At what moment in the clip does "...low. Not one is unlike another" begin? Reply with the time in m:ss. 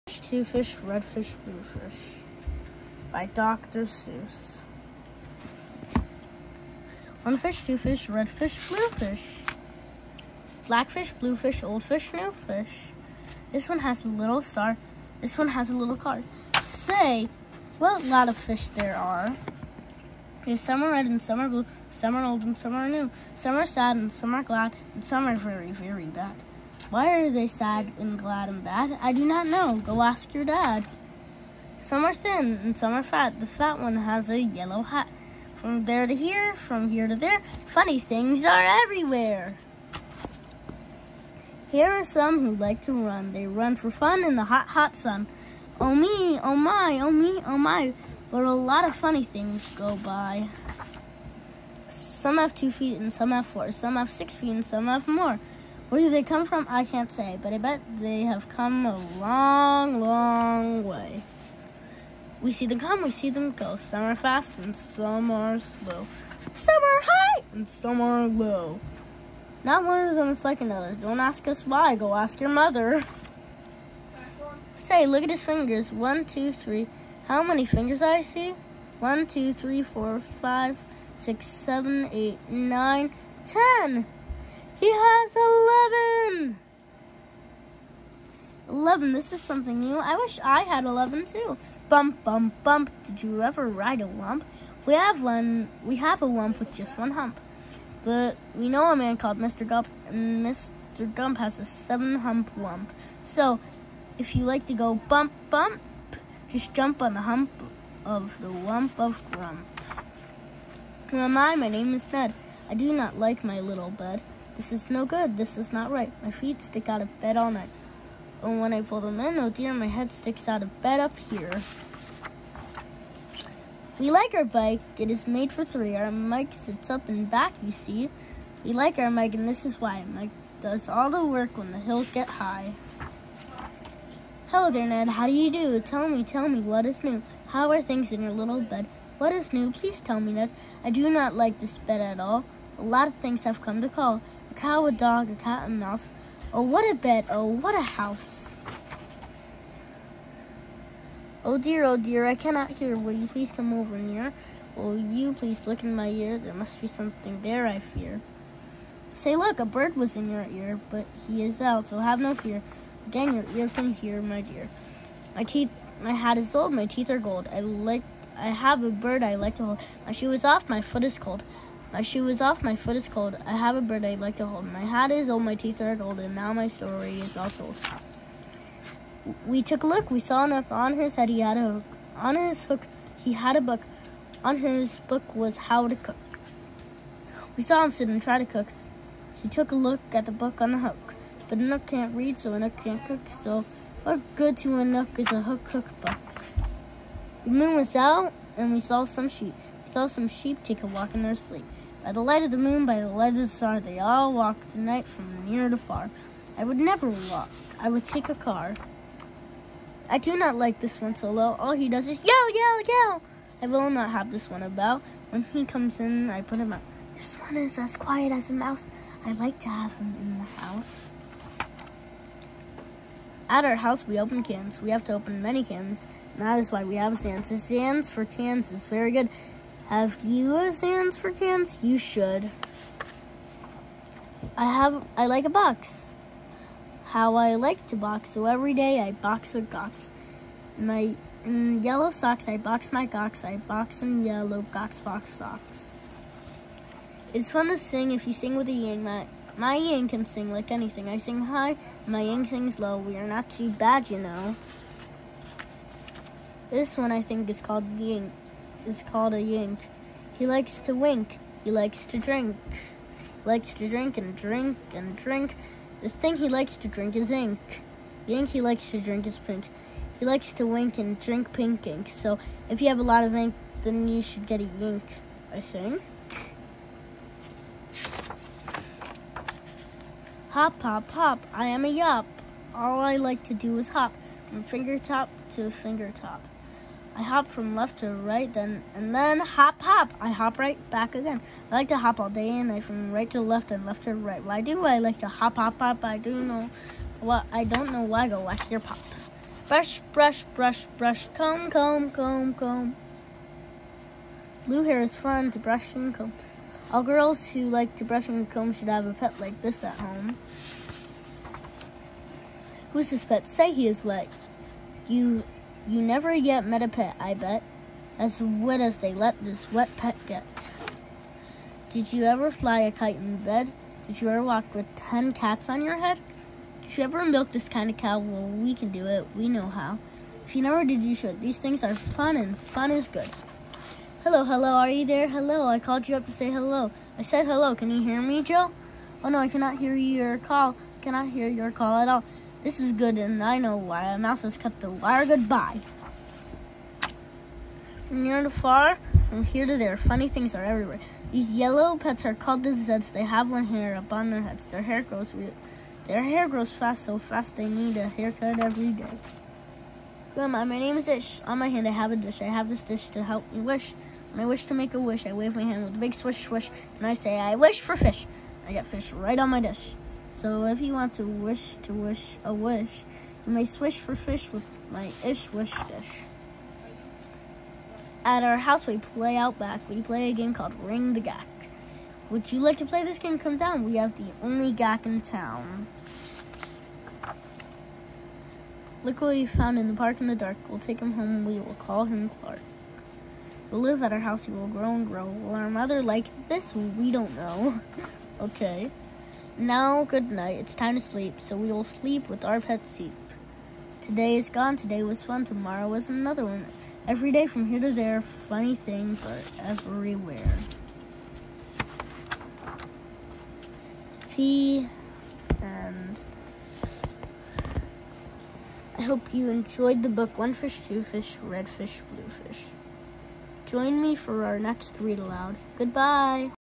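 1:08.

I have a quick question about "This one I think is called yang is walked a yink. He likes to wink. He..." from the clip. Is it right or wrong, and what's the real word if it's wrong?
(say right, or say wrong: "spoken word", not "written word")
wrong: "called", not "walked".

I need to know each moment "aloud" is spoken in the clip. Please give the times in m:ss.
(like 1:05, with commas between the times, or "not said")
7:05.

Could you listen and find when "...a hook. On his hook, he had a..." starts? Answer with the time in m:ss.
3:01.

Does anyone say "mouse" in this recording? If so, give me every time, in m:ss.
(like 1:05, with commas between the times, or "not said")
2:25, 3:38, 5:44.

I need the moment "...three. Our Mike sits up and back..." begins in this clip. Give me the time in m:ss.
2:05.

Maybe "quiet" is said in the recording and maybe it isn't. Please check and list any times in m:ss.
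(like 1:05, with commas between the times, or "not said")
3:37.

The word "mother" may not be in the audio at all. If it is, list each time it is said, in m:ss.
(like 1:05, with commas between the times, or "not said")
1:12, 6:35.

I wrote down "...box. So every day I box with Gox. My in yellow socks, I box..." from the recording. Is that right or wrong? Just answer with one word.
right.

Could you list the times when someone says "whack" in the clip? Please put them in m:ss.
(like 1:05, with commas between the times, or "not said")
4:58.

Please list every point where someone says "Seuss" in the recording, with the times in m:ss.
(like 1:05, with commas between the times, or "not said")
0:03.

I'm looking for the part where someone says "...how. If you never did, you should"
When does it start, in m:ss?
5:29.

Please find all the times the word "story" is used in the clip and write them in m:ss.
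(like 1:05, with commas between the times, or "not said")
2:56.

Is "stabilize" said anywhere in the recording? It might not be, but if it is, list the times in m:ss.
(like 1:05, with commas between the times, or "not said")
not said.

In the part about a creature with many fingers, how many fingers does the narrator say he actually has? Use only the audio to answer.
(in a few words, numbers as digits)
11.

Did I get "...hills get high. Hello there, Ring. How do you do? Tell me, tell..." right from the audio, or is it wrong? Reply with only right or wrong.
wrong.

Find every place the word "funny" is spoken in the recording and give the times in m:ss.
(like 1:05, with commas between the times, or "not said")
0:37, 0:48, 5:49, 6:48.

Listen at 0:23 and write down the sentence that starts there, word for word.
Some are sad and some are glad, and some are very, very bad.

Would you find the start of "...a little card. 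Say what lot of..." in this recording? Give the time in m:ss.
0:15.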